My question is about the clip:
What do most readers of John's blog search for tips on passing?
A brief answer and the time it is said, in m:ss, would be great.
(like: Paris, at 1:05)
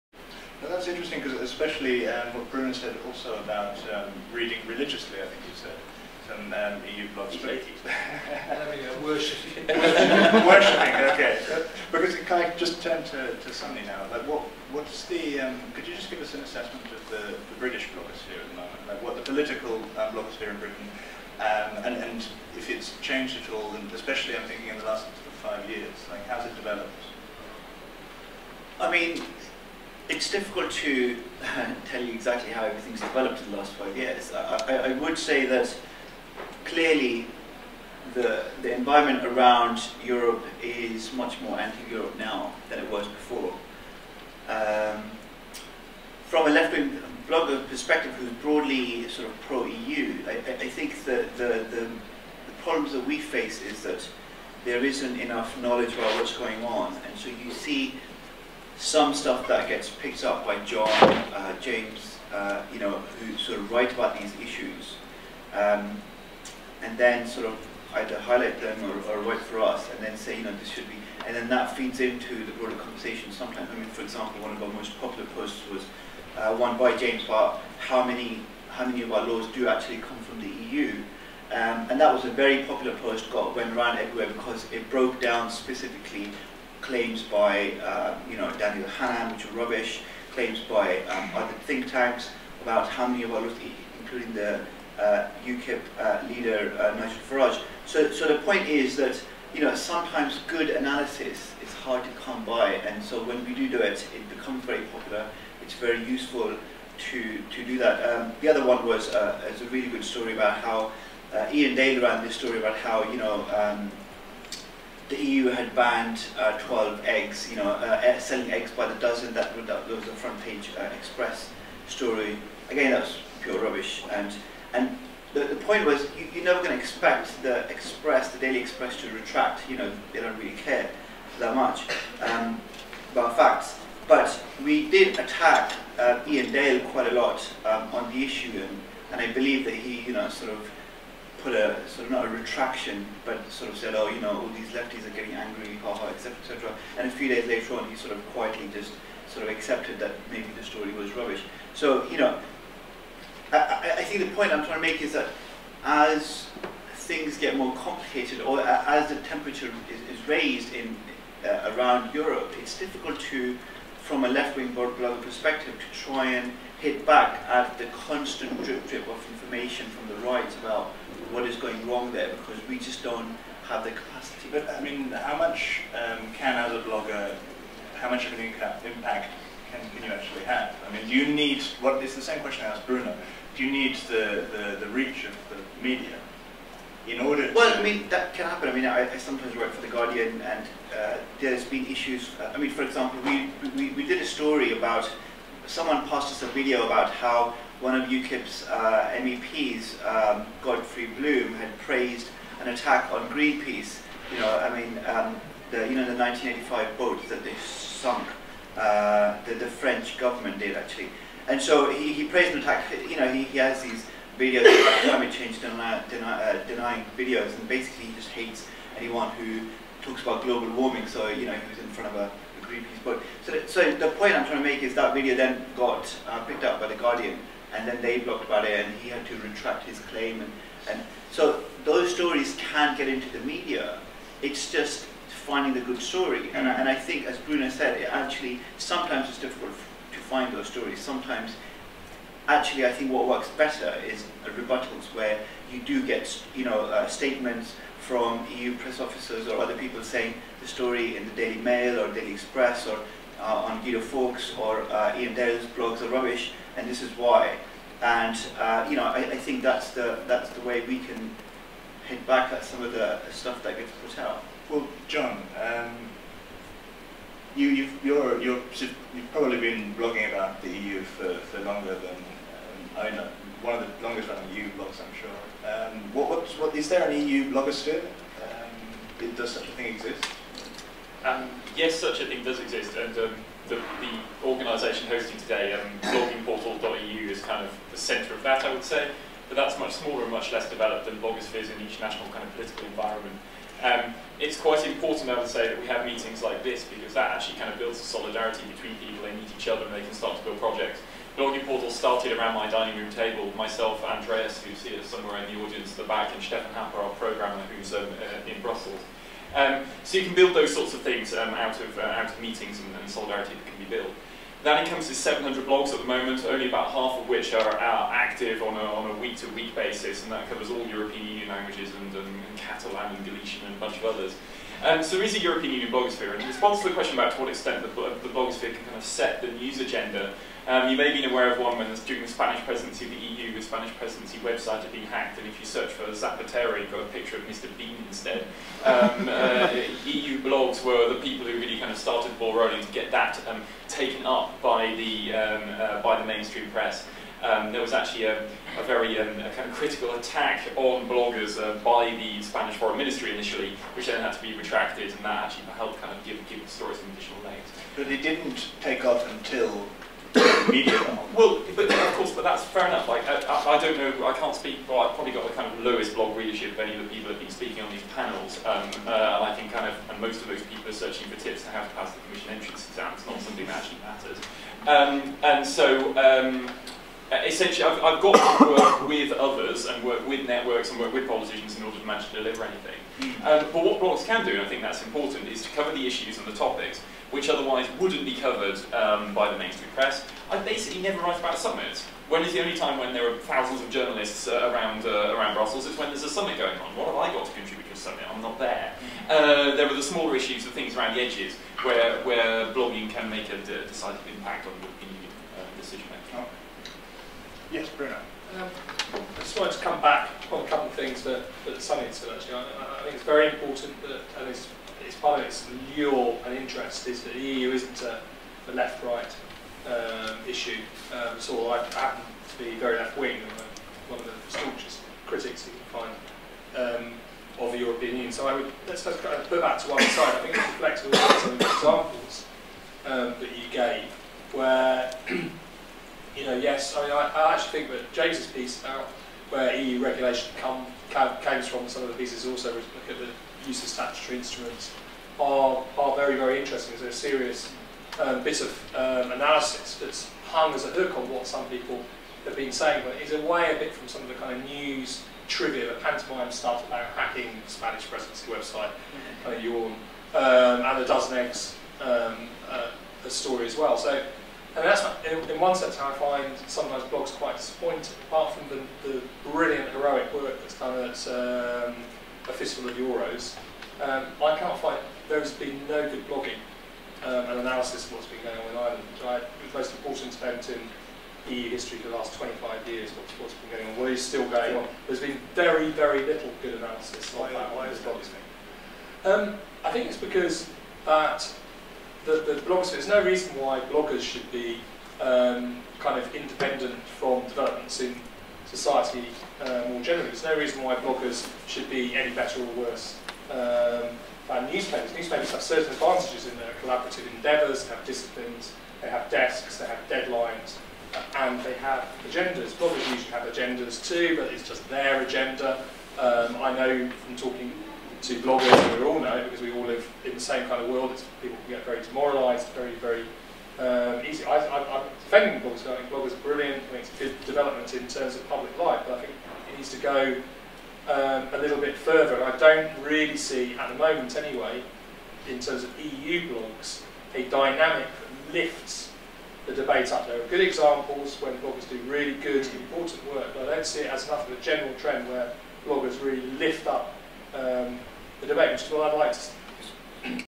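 Commission entrance exam, at 6:12.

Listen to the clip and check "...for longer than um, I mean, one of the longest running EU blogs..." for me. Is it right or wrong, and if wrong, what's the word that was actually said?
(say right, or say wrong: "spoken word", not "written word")
right.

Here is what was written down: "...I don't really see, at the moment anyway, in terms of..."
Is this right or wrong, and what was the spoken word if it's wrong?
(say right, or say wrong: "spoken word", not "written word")
right.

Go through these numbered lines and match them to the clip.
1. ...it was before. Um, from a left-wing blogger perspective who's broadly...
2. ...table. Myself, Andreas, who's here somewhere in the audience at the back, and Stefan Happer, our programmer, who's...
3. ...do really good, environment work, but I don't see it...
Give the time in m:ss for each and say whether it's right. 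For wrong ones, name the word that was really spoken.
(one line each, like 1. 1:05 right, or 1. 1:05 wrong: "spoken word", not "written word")
1. 0:42 right
2. 5:03 right
3. 9:01 wrong: "important", not "environment".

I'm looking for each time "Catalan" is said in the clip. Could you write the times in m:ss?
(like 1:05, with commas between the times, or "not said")
5:22.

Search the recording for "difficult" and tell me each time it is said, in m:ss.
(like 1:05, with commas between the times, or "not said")
0:30, 2:42, 3:59.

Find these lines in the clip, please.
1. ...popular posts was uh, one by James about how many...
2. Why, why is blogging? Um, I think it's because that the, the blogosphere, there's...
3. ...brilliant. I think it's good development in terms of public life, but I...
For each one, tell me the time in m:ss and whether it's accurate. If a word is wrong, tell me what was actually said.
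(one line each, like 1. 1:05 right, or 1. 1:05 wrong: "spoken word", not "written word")
1. 1:14 right
2. 8:07 right
3. 8:46 right.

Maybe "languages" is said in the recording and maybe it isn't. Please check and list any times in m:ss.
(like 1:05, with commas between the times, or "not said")
5:21.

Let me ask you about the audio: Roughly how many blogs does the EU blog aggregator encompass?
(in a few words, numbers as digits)
700.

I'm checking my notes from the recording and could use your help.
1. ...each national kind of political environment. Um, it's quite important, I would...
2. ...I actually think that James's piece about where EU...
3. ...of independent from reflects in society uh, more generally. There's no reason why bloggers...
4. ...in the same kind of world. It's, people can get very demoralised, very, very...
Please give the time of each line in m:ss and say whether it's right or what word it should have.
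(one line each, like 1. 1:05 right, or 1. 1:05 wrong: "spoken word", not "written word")
1. 4:51 right
2. 7:17 right
3. 8:16 wrong: "developments", not "reflects"
4. 8:40 right.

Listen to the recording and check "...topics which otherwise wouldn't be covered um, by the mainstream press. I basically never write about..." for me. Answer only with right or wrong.
right.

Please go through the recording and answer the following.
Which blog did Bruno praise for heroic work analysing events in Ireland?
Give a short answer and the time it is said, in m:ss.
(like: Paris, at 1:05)
A Fistful of Euros, at 7:52.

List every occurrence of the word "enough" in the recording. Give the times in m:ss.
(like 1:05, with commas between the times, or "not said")
0:55, 6:02, 9:04.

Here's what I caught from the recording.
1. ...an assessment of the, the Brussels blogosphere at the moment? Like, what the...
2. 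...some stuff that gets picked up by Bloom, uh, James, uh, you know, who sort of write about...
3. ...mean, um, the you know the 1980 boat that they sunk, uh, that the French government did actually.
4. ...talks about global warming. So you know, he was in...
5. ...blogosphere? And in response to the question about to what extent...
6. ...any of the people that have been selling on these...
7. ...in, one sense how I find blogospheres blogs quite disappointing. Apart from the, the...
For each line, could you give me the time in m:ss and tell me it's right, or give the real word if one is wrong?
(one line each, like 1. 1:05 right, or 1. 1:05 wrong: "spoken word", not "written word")
1. 0:16 wrong: "British", not "Brussels"
2. 0:58 wrong: "John", not "Bloom"
3. 3:24 wrong: "1985", not "1980"
4. 3:40 right
5. 5:25 right
6. 6:06 wrong: "speaking", not "selling"
7. 7:45 wrong: "sometimes", not "blogospheres".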